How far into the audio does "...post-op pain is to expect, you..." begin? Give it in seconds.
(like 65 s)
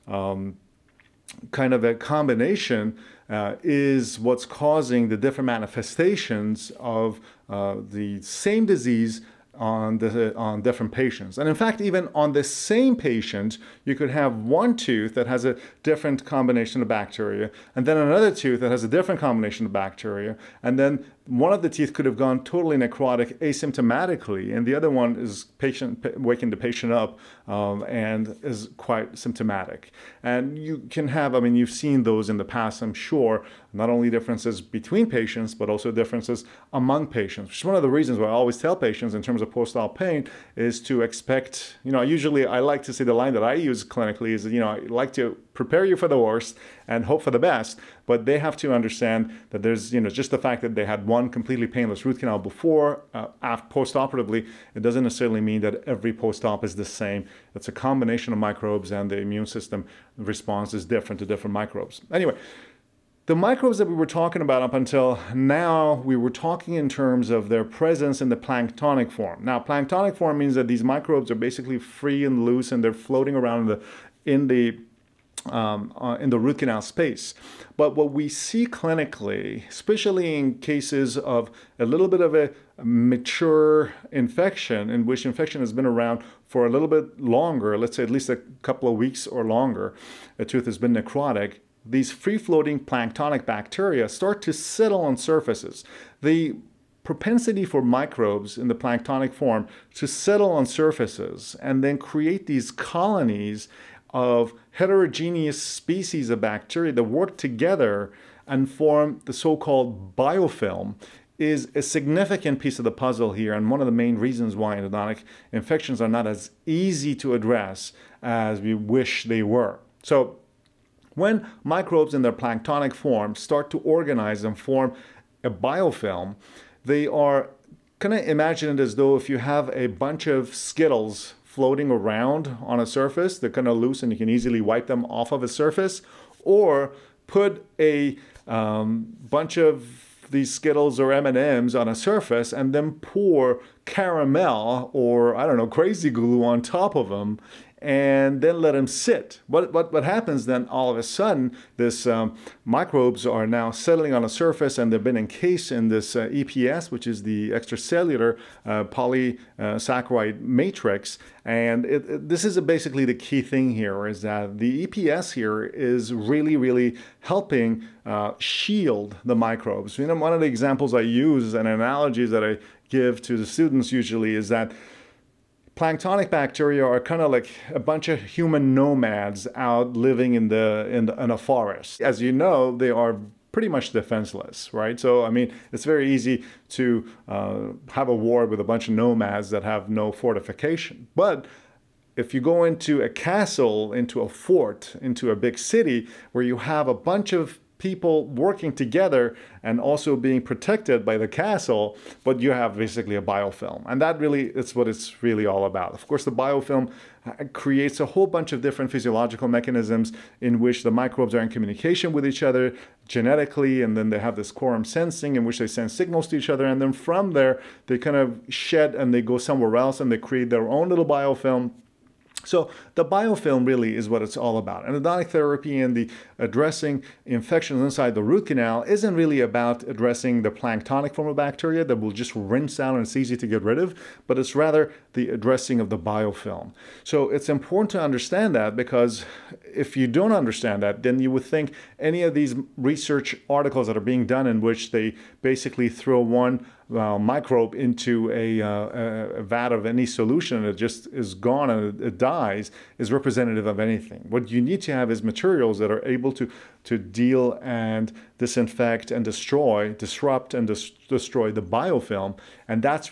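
39 s.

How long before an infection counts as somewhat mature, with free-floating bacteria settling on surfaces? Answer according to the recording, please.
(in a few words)
a couple of weeks.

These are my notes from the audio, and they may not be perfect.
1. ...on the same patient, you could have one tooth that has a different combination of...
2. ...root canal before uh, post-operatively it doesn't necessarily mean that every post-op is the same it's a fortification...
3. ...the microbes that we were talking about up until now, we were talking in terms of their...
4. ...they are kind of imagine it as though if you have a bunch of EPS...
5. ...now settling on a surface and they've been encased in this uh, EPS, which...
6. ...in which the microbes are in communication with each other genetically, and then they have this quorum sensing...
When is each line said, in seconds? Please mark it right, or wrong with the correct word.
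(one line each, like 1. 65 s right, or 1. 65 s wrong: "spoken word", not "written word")
1. 12 s right
2. 52 s wrong: "combination", not "fortification"
3. 63 s right
4. 126 s wrong: "Skittles", not "EPS"
5. 153 s right
6. 210 s right.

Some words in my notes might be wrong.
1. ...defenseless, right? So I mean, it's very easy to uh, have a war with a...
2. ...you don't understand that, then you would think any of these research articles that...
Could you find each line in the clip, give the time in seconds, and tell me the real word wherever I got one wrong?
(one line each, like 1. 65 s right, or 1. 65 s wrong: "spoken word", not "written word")
1. 183 s right
2. 239 s right.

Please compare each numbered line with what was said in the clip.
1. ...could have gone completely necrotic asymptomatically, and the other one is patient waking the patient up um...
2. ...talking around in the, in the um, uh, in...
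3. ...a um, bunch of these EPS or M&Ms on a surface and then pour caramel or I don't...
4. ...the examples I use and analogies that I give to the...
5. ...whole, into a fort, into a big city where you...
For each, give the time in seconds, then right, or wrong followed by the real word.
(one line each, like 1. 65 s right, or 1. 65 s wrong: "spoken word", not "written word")
1. 21 s wrong: "totally", not "completely"
2. 72 s wrong: "floating", not "talking"
3. 137 s wrong: "Skittles", not "EPS"
4. 170 s right
5. 193 s wrong: "castle", not "whole".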